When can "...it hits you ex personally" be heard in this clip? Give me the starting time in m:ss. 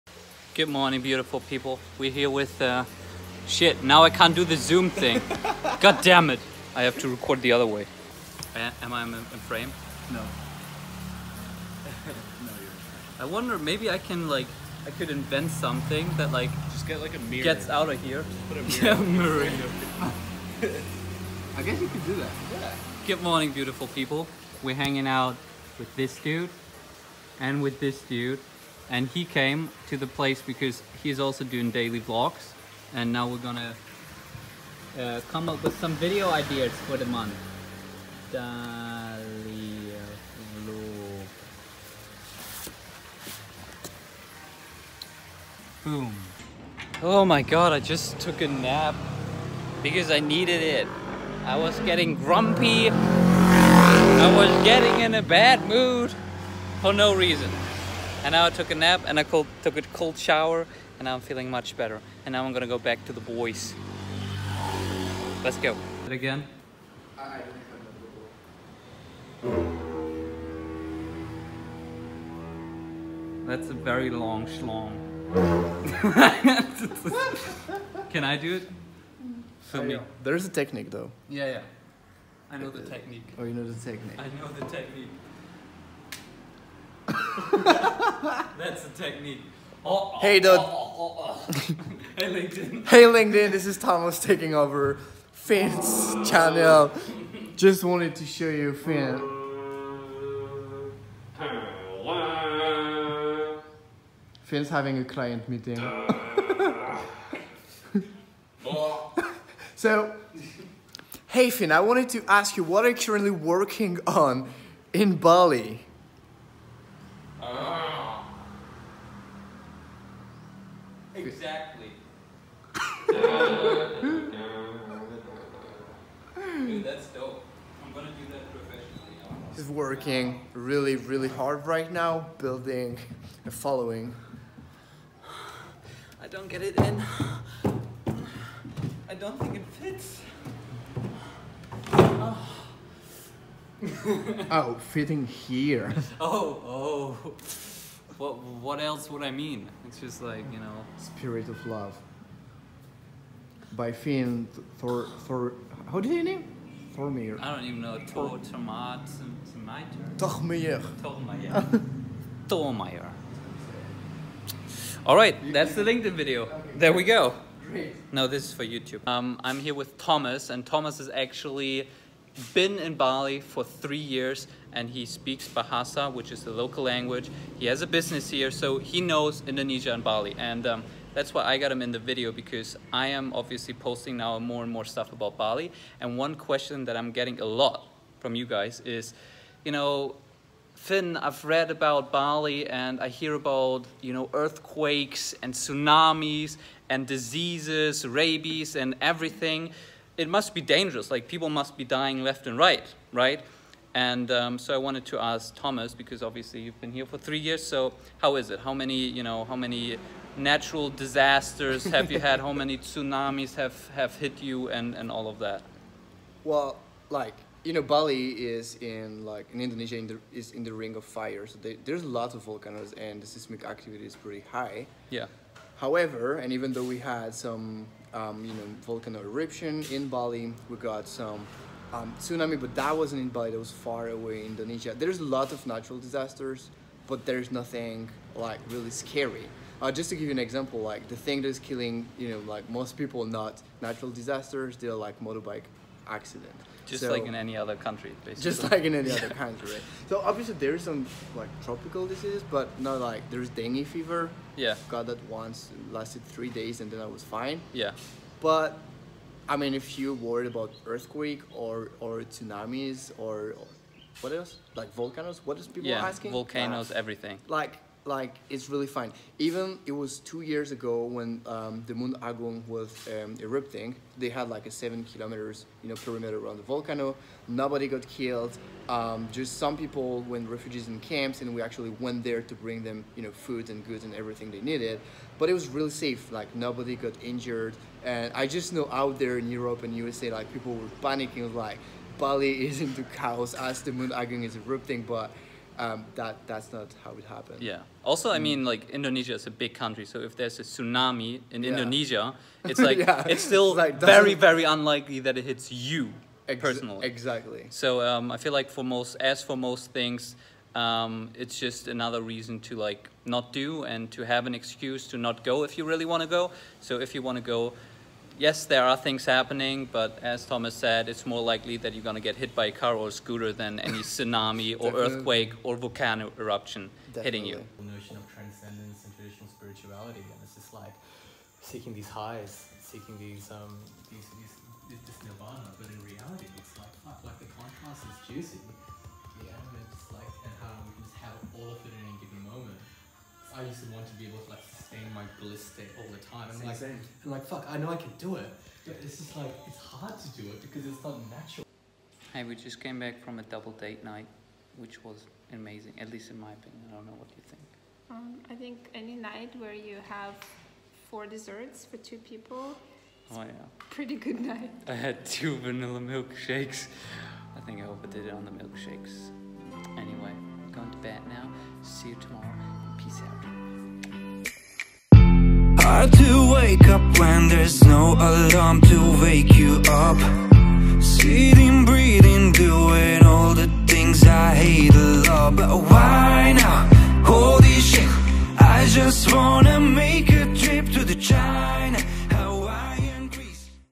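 5:05.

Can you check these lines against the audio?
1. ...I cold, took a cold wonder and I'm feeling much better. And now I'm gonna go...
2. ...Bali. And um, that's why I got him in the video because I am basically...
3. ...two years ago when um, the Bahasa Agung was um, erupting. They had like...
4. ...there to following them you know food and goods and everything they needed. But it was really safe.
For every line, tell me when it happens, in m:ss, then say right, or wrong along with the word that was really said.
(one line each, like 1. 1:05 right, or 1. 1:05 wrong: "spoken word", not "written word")
1. 0:59 wrong: "shower", not "wonder"
2. 3:00 wrong: "obviously", not "basically"
3. 4:30 wrong: "Mount", not "Bahasa"
4. 4:42 wrong: "bring", not "following".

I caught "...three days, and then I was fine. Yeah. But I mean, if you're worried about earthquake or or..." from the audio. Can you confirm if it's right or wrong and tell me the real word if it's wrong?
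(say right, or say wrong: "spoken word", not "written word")
right.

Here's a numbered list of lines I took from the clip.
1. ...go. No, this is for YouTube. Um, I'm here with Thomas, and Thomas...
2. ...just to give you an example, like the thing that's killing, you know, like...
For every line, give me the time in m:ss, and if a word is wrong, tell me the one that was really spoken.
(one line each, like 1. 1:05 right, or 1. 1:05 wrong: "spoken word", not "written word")
1. 2:47 right
2. 3:59 right.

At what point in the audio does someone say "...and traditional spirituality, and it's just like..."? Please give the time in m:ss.
5:29.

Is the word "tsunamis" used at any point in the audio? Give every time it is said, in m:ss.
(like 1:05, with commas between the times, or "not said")
3:15, 3:32, 3:52, 4:22, 5:00, 5:24.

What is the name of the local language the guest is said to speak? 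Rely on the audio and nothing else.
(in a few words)
Bahasa.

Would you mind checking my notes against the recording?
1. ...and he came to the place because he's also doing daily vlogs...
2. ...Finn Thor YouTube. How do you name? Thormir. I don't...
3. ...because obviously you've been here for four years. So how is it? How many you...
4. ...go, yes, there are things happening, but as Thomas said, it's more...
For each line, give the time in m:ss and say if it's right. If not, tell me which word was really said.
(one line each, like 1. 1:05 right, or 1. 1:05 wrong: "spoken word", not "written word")
1. 0:28 right
2. 2:33 wrong: "Thor", not "YouTube"
3. 3:25 wrong: "three", not "four"
4. 5:17 right.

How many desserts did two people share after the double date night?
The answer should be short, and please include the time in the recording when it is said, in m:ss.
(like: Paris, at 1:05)
4, at 6:01.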